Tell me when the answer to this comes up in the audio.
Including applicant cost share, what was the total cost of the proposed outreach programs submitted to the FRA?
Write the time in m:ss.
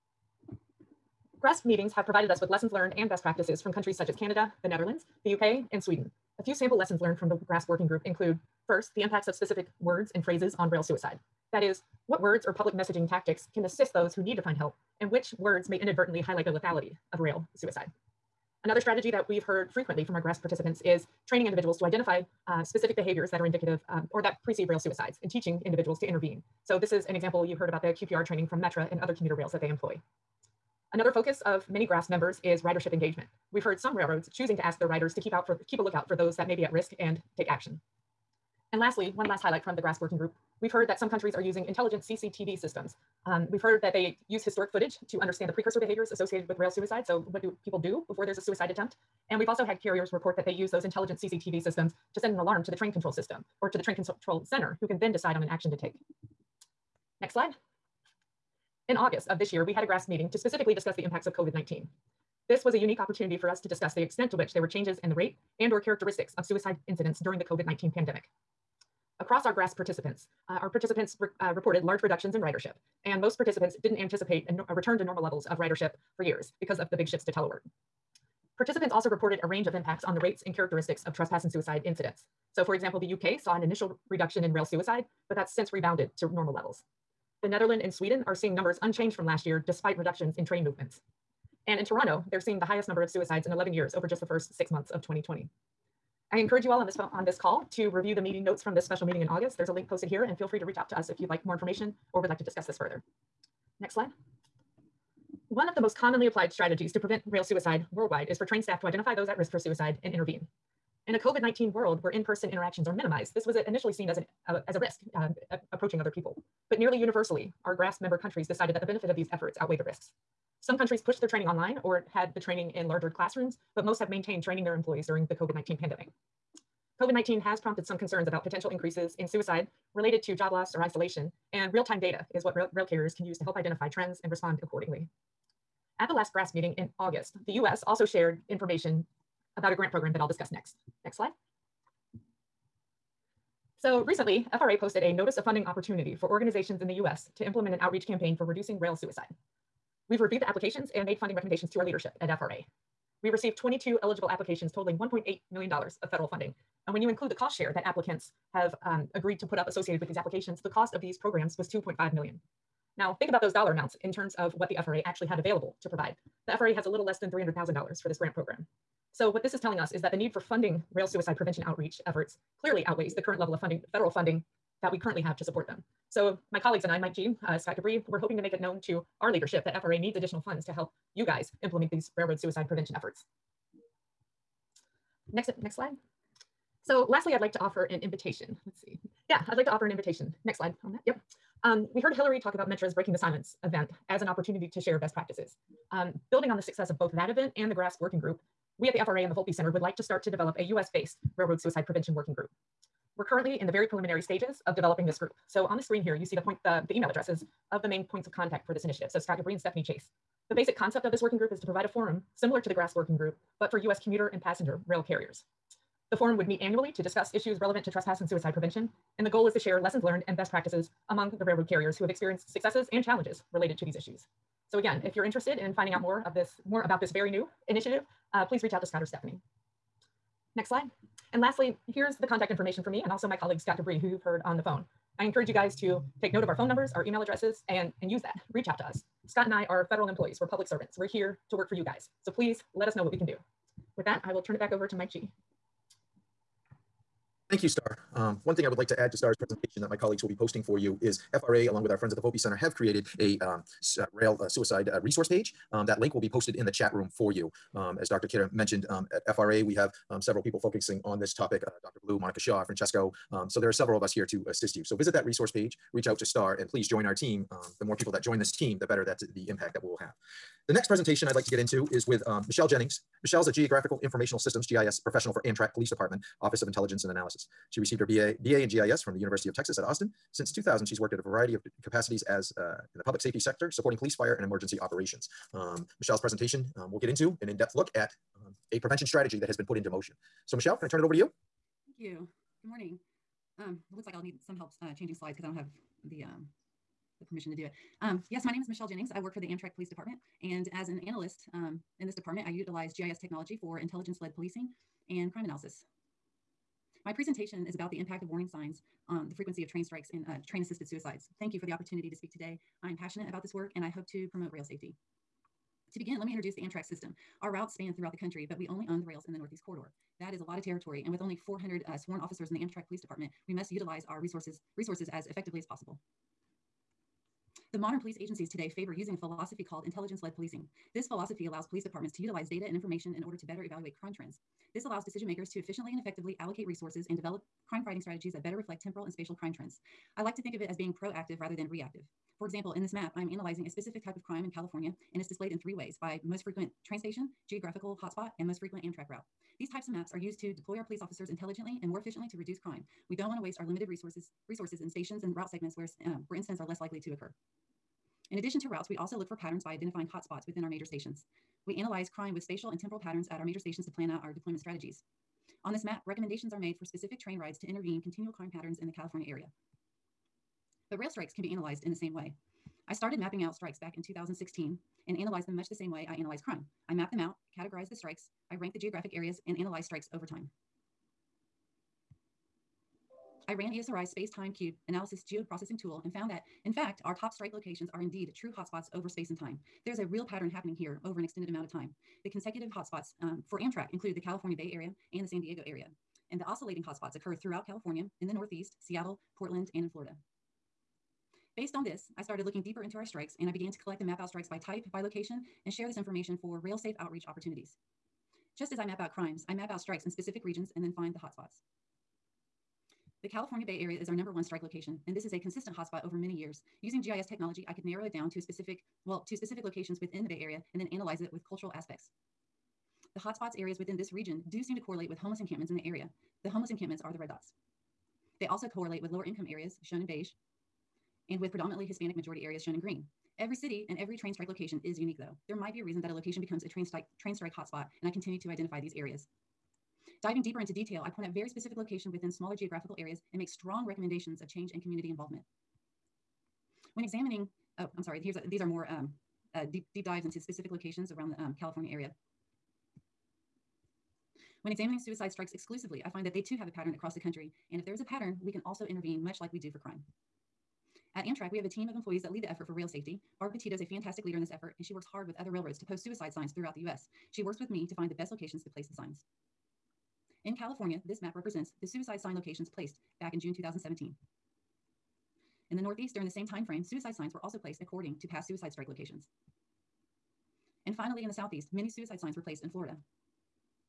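2:41.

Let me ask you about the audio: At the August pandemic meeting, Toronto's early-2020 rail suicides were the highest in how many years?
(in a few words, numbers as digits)
11.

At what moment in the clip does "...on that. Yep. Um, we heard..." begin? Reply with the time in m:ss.
3:10.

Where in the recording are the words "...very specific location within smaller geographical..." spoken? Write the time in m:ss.
7:21.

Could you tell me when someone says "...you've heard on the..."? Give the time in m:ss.
3:54.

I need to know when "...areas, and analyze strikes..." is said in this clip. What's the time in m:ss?
6:19.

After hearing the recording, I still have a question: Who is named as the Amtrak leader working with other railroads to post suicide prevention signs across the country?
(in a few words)
Barb Petito.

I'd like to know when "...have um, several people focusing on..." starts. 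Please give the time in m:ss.
4:19.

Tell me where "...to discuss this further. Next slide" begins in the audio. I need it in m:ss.
1:42.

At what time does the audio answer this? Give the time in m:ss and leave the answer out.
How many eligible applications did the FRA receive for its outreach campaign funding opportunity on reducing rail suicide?
2:33.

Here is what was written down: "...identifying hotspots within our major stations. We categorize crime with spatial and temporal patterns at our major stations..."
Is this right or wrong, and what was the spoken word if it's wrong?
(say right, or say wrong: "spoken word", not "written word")
wrong: "analyze", not "categorize".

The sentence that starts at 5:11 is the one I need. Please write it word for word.
Thank you for the opportunity to speak today.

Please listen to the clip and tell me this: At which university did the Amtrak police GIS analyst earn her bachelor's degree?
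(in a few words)
University of Texas at Austin.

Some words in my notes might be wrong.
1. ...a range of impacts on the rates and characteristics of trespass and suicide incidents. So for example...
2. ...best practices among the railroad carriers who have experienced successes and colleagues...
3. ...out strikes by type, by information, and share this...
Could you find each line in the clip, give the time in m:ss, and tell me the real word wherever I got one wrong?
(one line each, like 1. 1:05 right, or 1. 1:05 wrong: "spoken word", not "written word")
1. 1:19 right
2. 3:40 wrong: "challenges", not "colleagues"
3. 6:44 wrong: "location", not "information".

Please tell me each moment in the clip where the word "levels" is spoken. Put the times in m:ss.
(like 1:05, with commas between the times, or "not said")
1:15, 1:26, 2:53.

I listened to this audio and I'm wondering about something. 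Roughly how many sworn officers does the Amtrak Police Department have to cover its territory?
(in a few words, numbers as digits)
400.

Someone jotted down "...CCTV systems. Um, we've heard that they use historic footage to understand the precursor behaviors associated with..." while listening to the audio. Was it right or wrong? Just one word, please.
right.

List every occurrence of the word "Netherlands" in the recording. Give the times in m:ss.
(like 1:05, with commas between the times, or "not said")
0:04, 1:27.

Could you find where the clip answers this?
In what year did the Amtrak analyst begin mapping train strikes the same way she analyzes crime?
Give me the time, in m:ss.
6:14.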